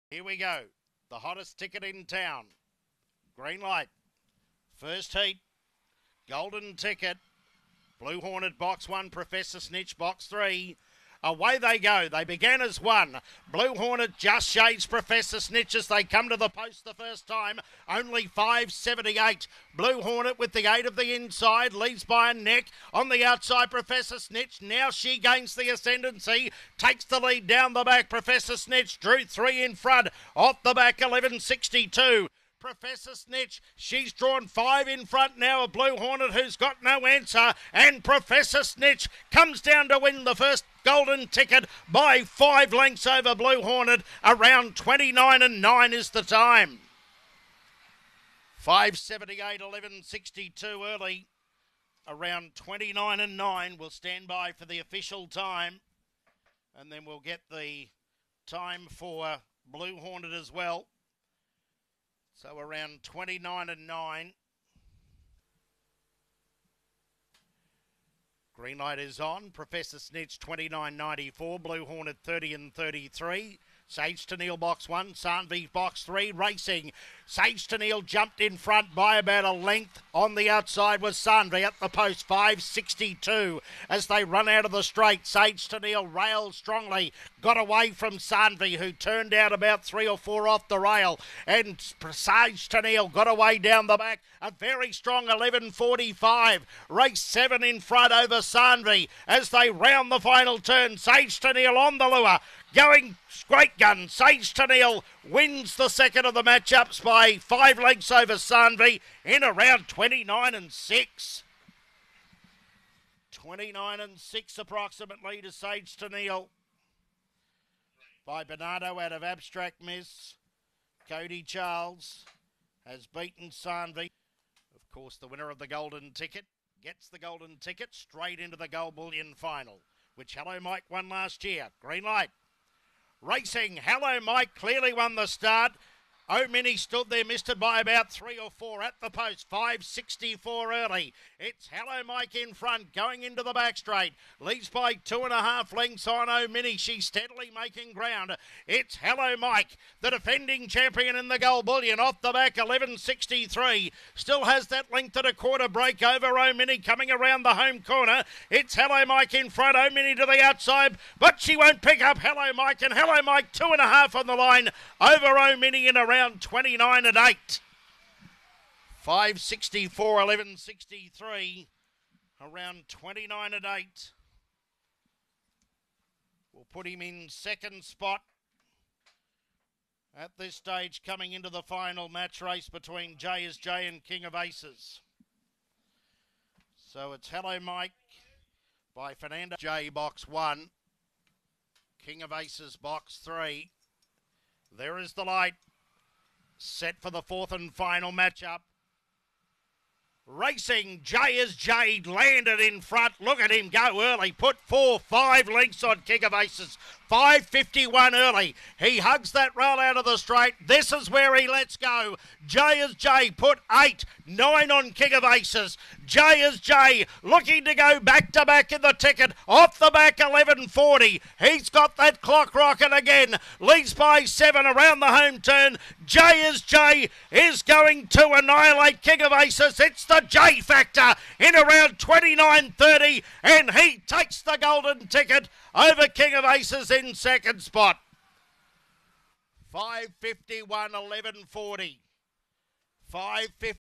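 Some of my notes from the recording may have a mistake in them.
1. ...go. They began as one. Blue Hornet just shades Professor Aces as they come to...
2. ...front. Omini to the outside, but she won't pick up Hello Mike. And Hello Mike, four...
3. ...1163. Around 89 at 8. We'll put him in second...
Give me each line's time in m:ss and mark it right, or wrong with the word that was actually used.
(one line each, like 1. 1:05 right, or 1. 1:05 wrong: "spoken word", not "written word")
1. 0:11 wrong: "Snitch", not "Aces"
2. 2:39 wrong: "two", not "four"
3. 2:50 wrong: "29", not "89".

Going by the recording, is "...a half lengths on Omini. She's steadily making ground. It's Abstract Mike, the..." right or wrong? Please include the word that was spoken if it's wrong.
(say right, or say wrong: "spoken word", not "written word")
wrong: "Hello", not "Abstract".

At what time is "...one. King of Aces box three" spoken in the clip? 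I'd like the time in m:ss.
3:10.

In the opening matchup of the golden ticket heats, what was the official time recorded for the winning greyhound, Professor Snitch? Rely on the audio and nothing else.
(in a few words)
29.94.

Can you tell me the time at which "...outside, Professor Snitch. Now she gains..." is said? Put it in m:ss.
0:23.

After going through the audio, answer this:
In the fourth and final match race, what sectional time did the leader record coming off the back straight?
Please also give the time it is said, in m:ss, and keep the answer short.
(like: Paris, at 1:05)
11.40, at 3:39.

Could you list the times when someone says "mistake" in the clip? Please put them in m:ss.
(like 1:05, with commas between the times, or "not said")
not said.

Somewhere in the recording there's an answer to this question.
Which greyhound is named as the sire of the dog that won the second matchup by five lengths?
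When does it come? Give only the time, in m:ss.
1:58.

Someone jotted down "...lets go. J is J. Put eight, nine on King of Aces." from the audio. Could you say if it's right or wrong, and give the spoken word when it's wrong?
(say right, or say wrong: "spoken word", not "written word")
right.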